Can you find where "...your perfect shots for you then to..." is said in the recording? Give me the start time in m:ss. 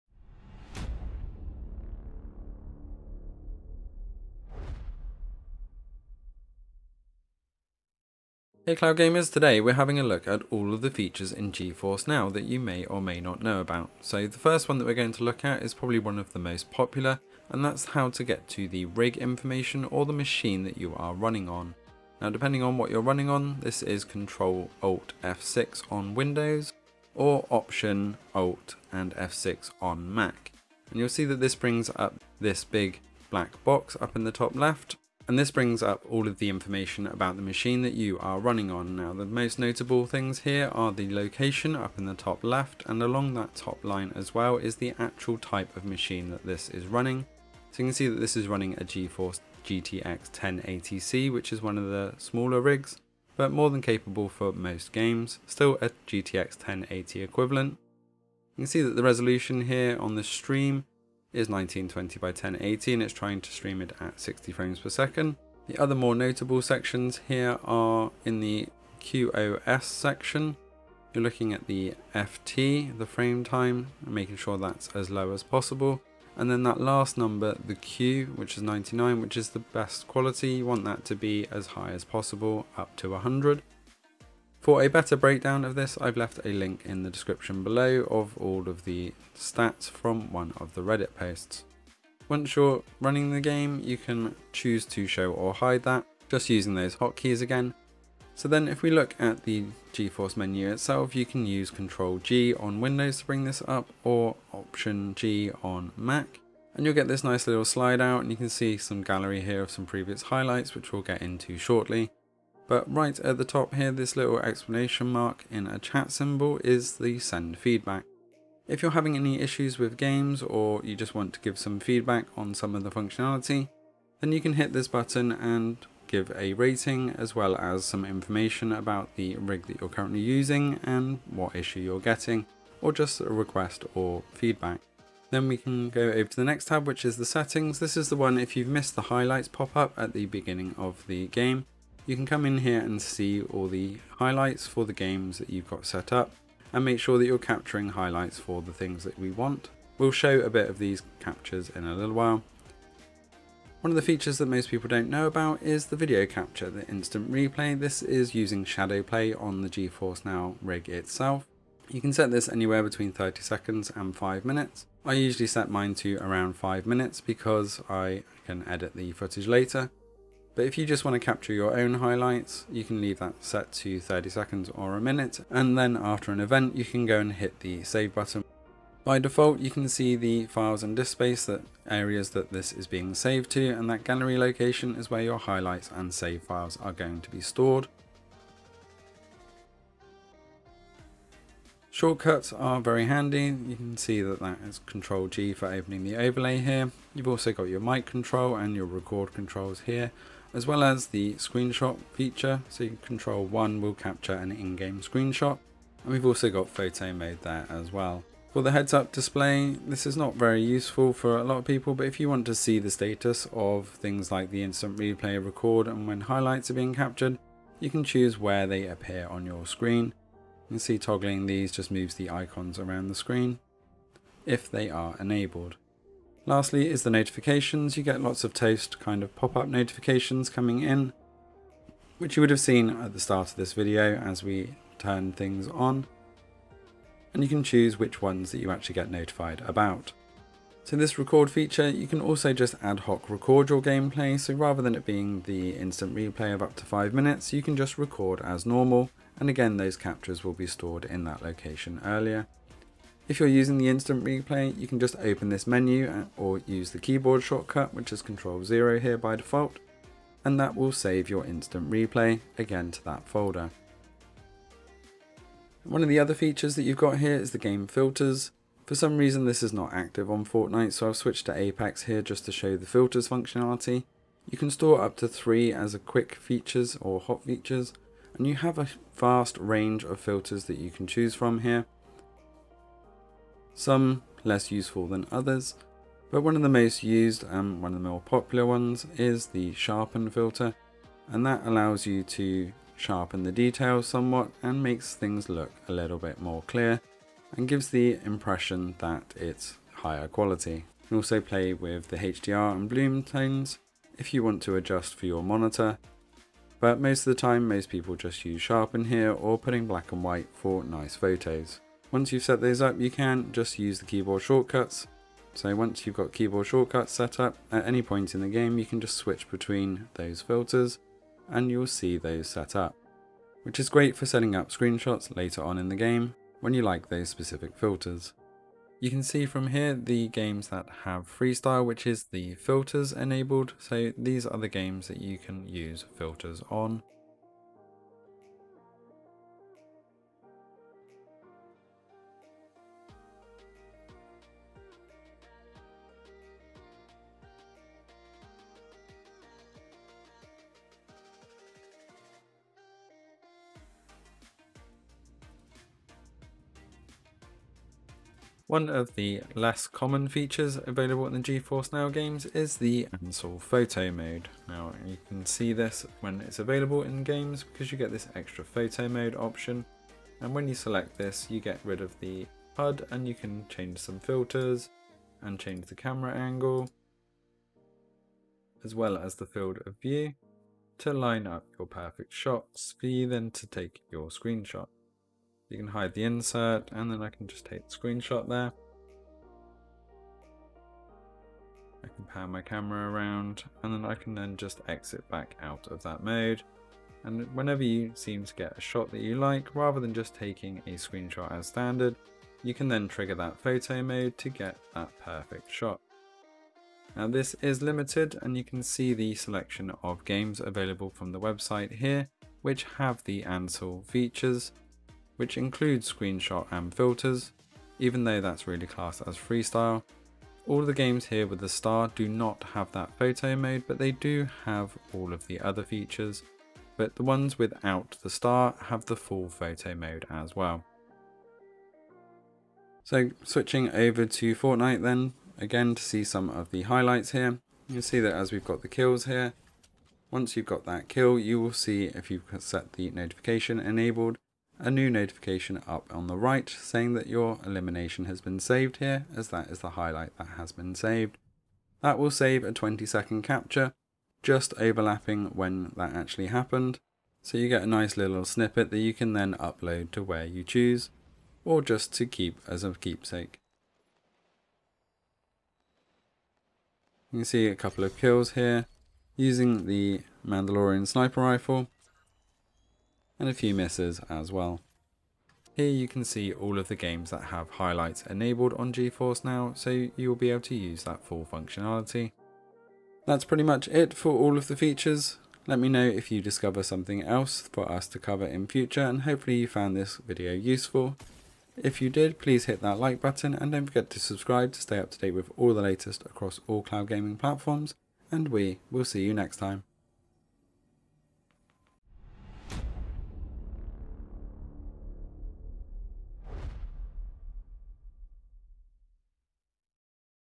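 6:21.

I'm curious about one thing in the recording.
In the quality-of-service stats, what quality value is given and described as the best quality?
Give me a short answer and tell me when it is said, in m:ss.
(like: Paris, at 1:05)
99, at 1:18.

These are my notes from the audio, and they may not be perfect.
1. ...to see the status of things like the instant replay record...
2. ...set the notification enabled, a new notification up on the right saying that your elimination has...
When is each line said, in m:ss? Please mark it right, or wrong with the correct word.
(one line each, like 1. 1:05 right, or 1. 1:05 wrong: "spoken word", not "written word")
1. 3:32 right
2. 7:22 right.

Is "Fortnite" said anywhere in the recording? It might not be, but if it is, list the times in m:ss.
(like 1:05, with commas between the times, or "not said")
4:30, 7:14.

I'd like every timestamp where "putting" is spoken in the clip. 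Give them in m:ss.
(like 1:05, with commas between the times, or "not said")
5:09.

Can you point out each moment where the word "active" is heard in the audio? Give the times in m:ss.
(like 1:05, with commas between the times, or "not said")
4:29.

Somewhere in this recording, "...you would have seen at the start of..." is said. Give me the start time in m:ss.
3:52.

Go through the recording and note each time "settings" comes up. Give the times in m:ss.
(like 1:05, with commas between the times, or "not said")
2:17, 5:24.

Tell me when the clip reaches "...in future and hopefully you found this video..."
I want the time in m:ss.
8:08.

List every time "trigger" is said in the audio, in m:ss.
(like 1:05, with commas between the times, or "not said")
6:43.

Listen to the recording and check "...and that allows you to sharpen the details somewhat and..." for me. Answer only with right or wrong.
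right.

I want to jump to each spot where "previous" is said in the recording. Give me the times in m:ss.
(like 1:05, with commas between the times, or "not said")
1:49.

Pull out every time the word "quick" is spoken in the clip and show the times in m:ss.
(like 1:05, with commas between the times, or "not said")
4:35.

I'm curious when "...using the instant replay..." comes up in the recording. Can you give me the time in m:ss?
4:13.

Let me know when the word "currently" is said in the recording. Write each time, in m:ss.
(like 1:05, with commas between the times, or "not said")
2:09.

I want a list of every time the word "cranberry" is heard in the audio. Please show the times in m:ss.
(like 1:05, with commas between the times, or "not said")
not said.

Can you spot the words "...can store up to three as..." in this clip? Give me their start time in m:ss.
4:34.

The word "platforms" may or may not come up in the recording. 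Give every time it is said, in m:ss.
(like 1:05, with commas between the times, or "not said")
8:17.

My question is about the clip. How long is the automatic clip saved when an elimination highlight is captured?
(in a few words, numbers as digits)
20 seconds.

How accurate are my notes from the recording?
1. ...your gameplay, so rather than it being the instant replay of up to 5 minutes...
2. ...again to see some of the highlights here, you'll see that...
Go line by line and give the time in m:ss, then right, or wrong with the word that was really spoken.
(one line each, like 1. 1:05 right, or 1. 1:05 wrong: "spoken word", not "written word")
1. 4:03 right
2. 7:15 right.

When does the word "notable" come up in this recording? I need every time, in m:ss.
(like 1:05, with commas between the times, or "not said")
0:39, 1:06.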